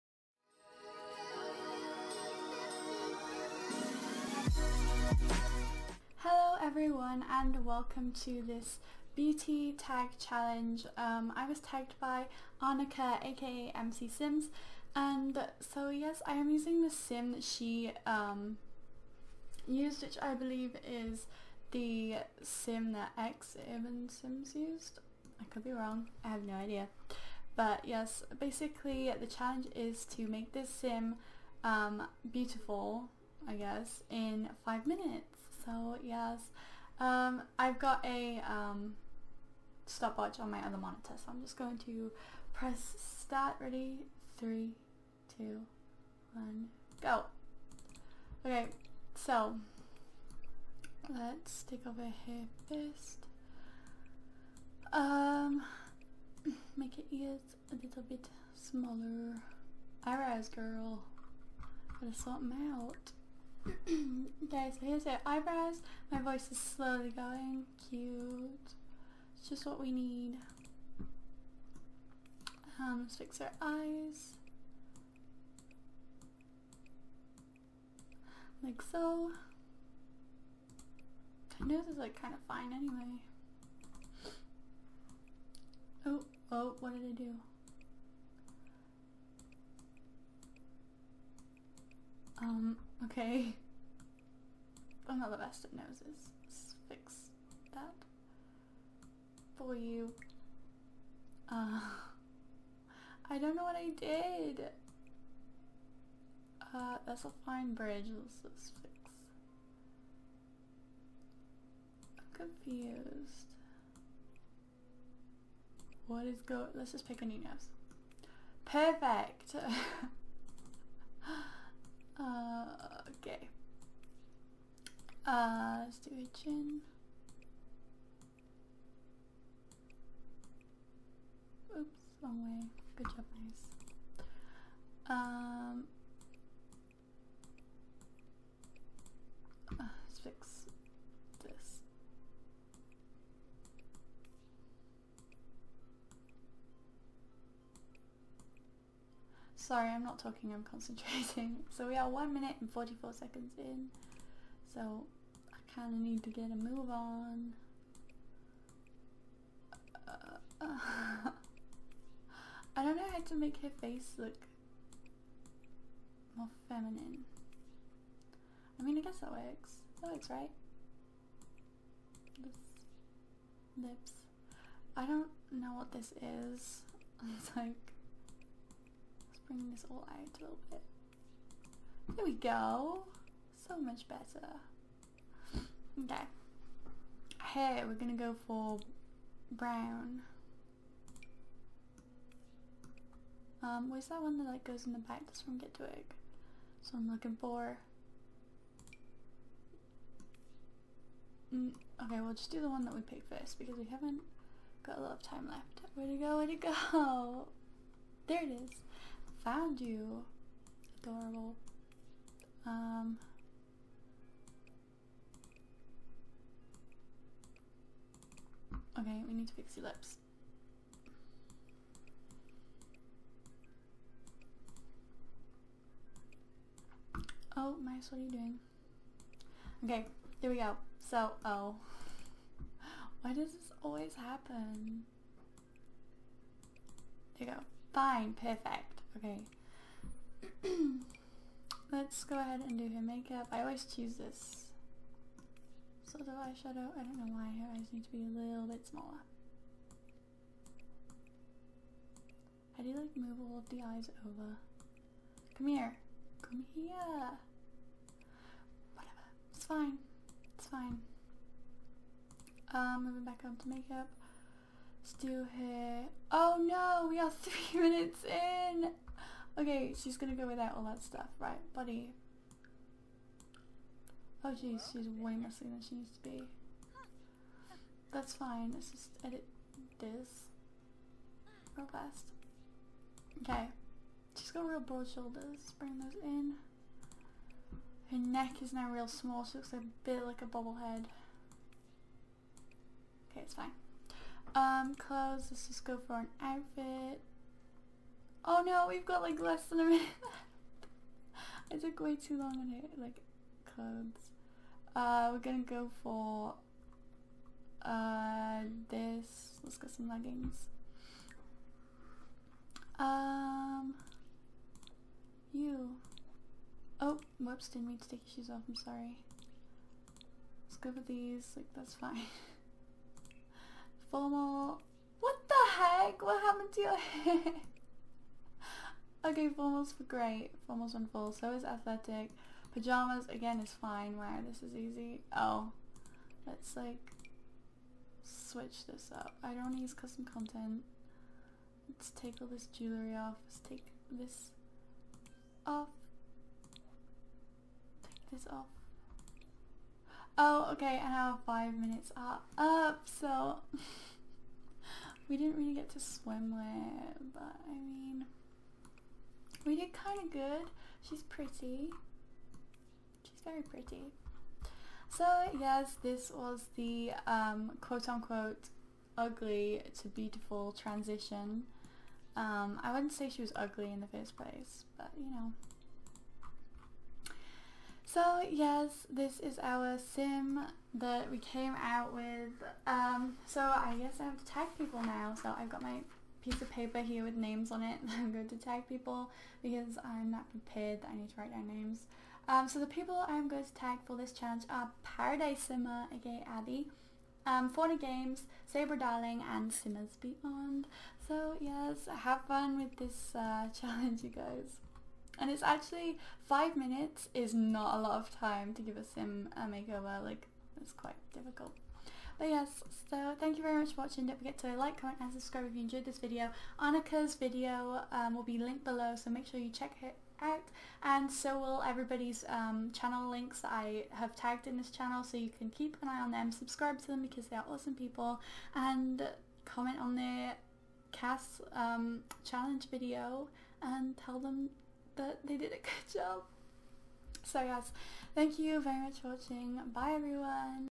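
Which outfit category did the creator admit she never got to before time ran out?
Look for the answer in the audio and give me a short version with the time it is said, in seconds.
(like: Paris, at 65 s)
Swimwear, at 355 s.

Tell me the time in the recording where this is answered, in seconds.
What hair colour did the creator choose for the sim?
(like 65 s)
189 s.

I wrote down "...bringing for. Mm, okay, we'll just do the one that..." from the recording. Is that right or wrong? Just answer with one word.
wrong.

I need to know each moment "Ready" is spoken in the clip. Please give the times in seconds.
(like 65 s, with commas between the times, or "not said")
43 s.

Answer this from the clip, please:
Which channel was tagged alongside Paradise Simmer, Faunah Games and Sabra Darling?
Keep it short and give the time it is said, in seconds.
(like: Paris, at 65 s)
Simmers Beyond, at 399 s.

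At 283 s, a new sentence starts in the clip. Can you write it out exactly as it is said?
Okay, she's got real broad shoulders, bring those in.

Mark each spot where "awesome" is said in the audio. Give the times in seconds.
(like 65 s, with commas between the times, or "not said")
427 s.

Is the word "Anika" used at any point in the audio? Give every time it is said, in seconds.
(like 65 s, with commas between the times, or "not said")
12 s, 416 s.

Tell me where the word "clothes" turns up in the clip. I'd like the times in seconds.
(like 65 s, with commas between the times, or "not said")
294 s, 303 s.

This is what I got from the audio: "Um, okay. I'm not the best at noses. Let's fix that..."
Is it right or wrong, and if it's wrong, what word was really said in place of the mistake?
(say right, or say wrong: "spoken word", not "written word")
right.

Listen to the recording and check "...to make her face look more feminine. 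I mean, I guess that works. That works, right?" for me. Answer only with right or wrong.
right.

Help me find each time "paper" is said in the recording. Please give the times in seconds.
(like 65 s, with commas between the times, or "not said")
386 s.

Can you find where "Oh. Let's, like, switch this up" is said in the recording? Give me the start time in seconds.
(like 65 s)
335 s.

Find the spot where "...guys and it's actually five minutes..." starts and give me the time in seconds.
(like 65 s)
404 s.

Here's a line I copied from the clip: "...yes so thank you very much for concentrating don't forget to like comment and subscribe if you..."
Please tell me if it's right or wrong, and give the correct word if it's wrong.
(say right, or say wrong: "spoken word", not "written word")
wrong: "watching", not "concentrating".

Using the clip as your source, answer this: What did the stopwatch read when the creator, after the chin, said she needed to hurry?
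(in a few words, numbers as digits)
1 minute and 44 seconds.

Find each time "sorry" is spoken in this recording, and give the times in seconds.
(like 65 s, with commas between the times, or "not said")
149 s, 318 s.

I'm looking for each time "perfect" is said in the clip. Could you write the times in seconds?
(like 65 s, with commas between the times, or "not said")
118 s, 238 s.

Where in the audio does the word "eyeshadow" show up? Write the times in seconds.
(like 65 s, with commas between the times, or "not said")
246 s.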